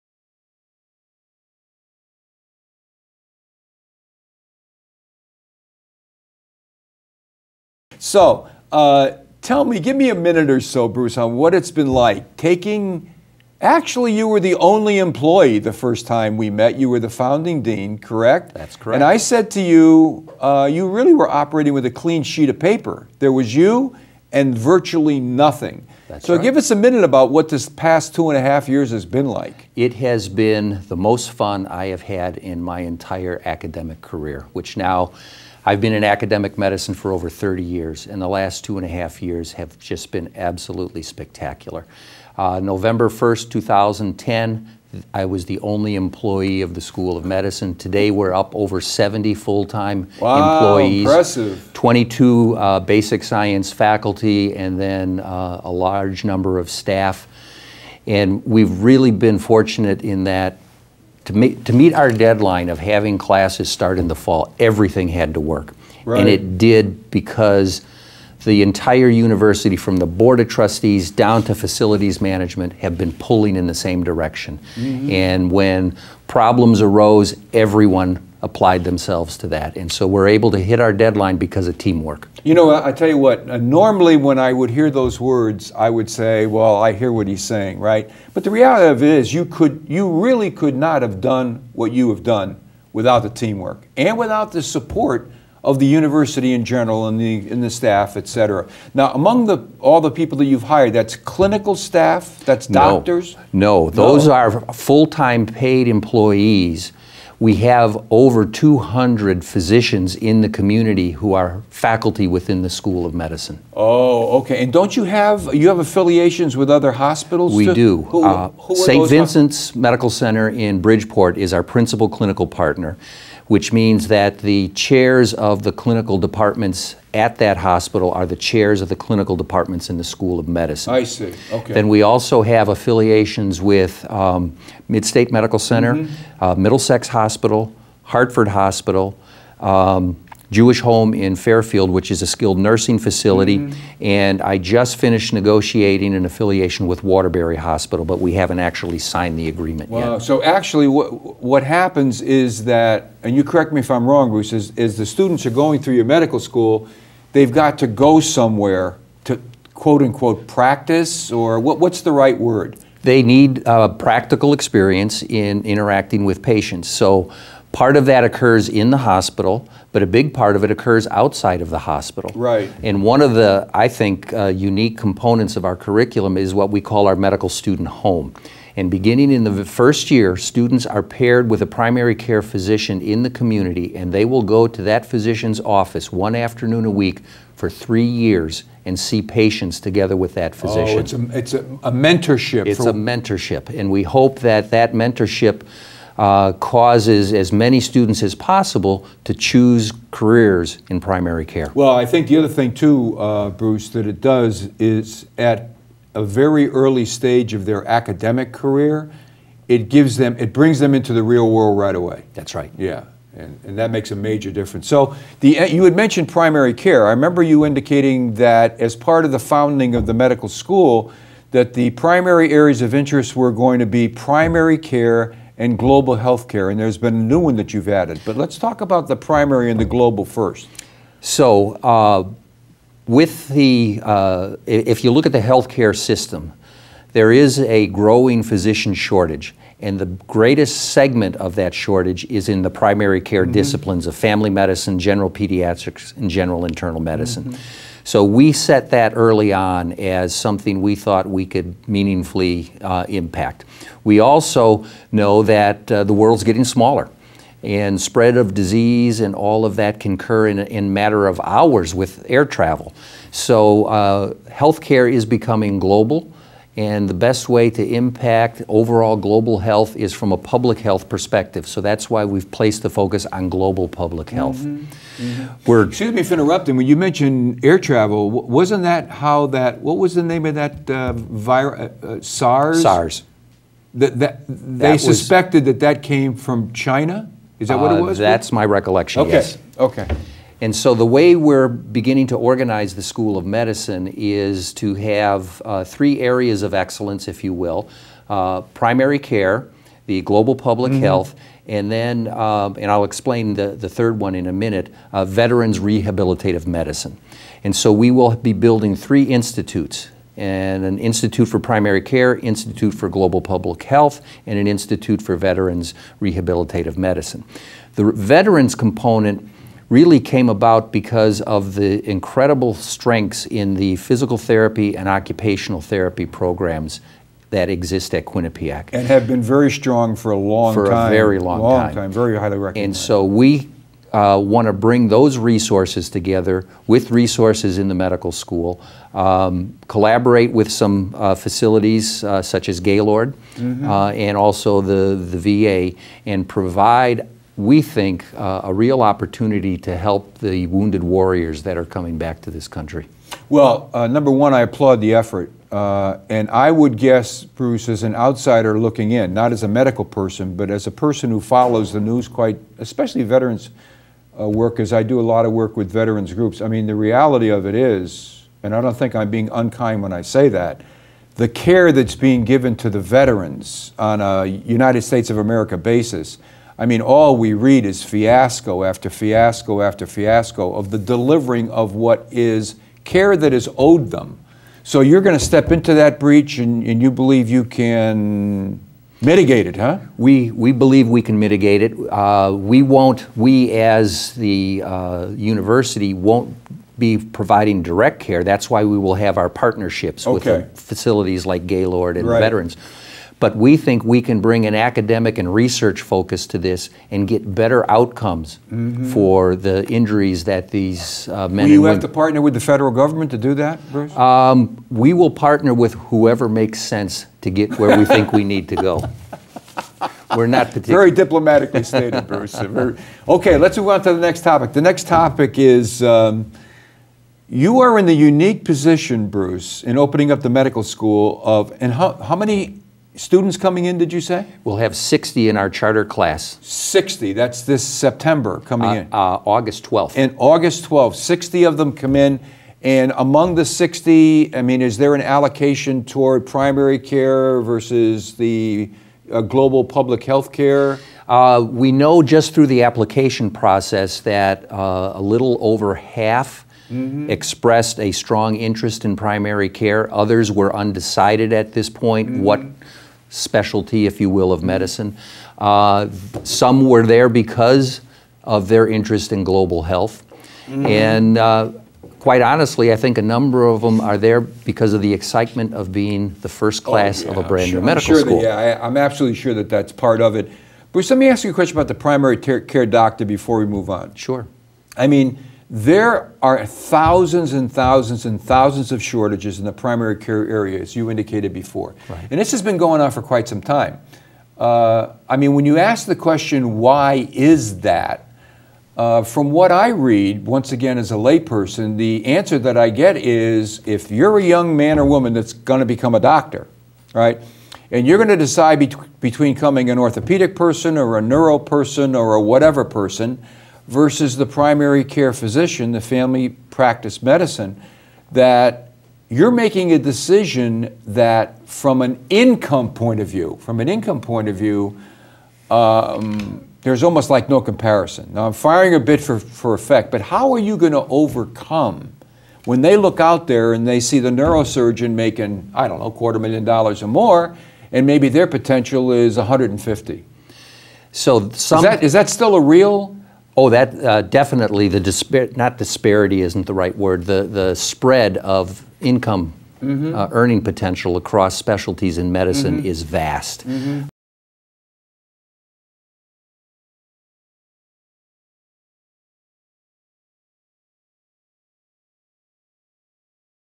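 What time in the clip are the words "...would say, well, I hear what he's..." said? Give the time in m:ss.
1:25.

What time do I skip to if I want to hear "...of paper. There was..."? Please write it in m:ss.
0:22.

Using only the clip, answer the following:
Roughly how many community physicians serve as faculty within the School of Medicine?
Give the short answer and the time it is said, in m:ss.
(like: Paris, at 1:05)
over 200, at 1:48.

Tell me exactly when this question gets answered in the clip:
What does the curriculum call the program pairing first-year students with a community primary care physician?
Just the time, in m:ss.
2:57.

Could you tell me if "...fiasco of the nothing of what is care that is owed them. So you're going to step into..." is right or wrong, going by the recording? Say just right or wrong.
wrong.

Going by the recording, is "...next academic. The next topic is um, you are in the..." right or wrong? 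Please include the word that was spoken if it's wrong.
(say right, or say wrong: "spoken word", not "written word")
wrong: "topic", not "academic".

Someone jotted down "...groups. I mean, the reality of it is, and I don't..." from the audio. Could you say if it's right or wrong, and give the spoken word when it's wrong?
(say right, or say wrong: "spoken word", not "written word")
right.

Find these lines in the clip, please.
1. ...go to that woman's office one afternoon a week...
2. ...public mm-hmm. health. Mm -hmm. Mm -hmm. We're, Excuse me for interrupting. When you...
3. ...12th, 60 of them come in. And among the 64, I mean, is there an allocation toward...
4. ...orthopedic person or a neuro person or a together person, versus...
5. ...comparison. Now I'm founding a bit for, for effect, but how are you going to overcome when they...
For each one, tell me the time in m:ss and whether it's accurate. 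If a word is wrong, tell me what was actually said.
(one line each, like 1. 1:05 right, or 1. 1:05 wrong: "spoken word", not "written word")
1. 3:04 wrong: "physician", not "woman"
2. 4:33 right
3. 7:20 wrong: "60", not "64"
4. 8:29 wrong: "whatever", not "together"
5. 8:47 wrong: "firing", not "founding".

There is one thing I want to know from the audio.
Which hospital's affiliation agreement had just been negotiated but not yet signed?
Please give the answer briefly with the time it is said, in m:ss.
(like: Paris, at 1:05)
Waterbury Hospital, at 2:27.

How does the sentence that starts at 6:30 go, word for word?
We, we believe we can mitigate it.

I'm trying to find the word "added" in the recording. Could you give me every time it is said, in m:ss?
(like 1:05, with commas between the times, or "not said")
3:47.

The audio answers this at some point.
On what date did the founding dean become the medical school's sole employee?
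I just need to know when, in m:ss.
0:42.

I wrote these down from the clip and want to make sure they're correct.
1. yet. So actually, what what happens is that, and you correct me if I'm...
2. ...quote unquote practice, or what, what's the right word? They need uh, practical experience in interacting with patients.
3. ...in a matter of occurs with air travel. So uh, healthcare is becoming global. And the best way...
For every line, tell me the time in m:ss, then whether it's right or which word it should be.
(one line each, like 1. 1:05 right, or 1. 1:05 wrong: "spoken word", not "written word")
1. 2:30 right
2. 2:39 right
3. 4:20 wrong: "hours", not "occurs".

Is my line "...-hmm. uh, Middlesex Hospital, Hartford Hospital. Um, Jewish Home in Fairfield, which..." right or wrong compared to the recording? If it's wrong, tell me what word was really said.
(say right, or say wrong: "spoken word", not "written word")
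right.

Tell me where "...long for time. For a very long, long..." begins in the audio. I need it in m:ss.
5:30.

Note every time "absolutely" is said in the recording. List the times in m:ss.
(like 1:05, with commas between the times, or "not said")
0:40, 7:58.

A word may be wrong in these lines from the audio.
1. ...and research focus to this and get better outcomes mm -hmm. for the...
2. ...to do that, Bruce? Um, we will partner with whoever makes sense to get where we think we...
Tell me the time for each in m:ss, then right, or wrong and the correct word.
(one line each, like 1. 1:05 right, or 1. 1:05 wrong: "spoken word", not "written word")
1. 6:45 right
2. 6:53 right.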